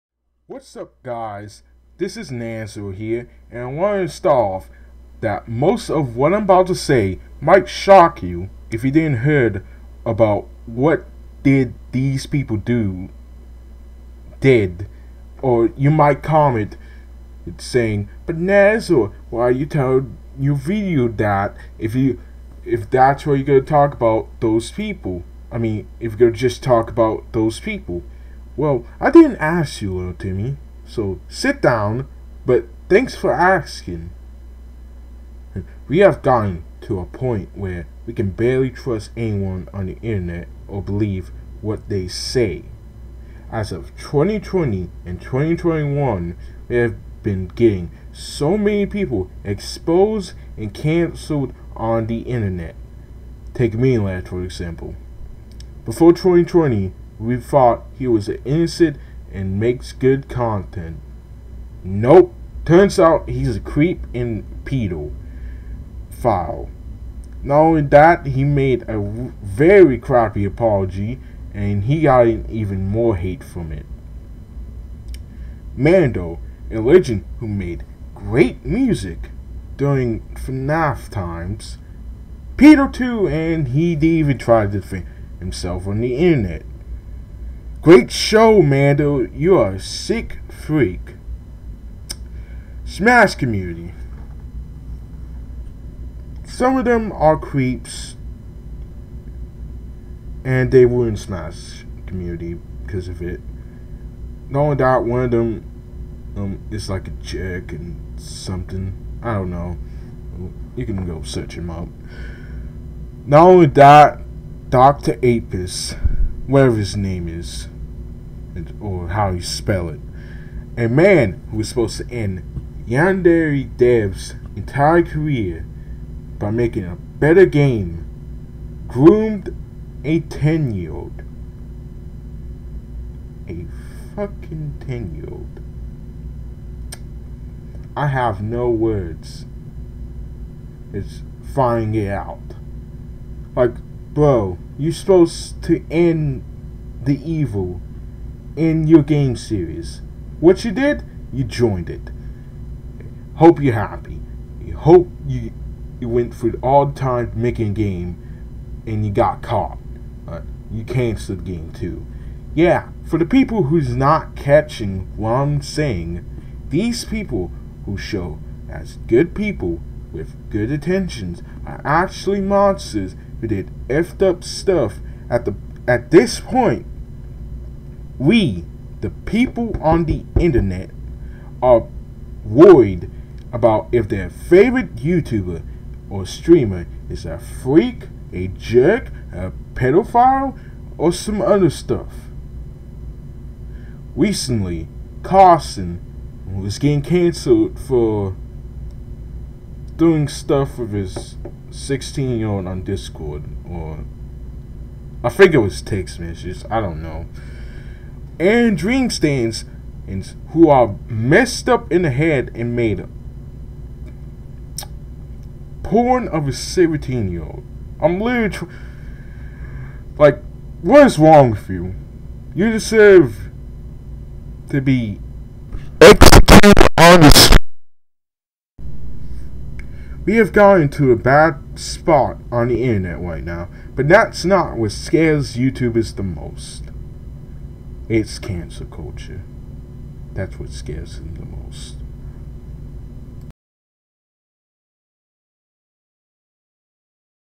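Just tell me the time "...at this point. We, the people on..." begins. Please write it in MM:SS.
02:55.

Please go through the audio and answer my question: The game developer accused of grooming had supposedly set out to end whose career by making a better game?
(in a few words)
Yandere Dev.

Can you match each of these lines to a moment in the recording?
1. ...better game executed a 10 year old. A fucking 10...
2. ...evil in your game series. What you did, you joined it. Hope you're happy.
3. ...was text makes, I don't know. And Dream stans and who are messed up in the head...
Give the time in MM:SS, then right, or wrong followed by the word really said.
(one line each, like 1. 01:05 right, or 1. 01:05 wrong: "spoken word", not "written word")
1. 02:06 wrong: "groomed", not "executed"
2. 02:27 right
3. 03:25 wrong: "messages", not "makes".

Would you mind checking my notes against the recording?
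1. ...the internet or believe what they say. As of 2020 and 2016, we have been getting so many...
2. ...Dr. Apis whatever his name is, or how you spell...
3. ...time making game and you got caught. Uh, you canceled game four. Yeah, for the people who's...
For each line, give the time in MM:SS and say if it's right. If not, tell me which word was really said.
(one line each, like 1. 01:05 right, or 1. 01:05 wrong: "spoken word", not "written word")
1. 00:39 wrong: "2021", not "2016"
2. 01:54 right
3. 02:36 wrong: "two", not "four".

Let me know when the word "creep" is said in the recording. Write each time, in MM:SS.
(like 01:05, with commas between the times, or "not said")
01:03, 01:37.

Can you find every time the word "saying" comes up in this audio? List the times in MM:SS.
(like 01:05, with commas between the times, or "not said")
00:17, 02:45.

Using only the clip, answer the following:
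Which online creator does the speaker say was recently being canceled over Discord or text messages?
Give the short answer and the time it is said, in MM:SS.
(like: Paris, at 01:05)
Carson, at 03:15.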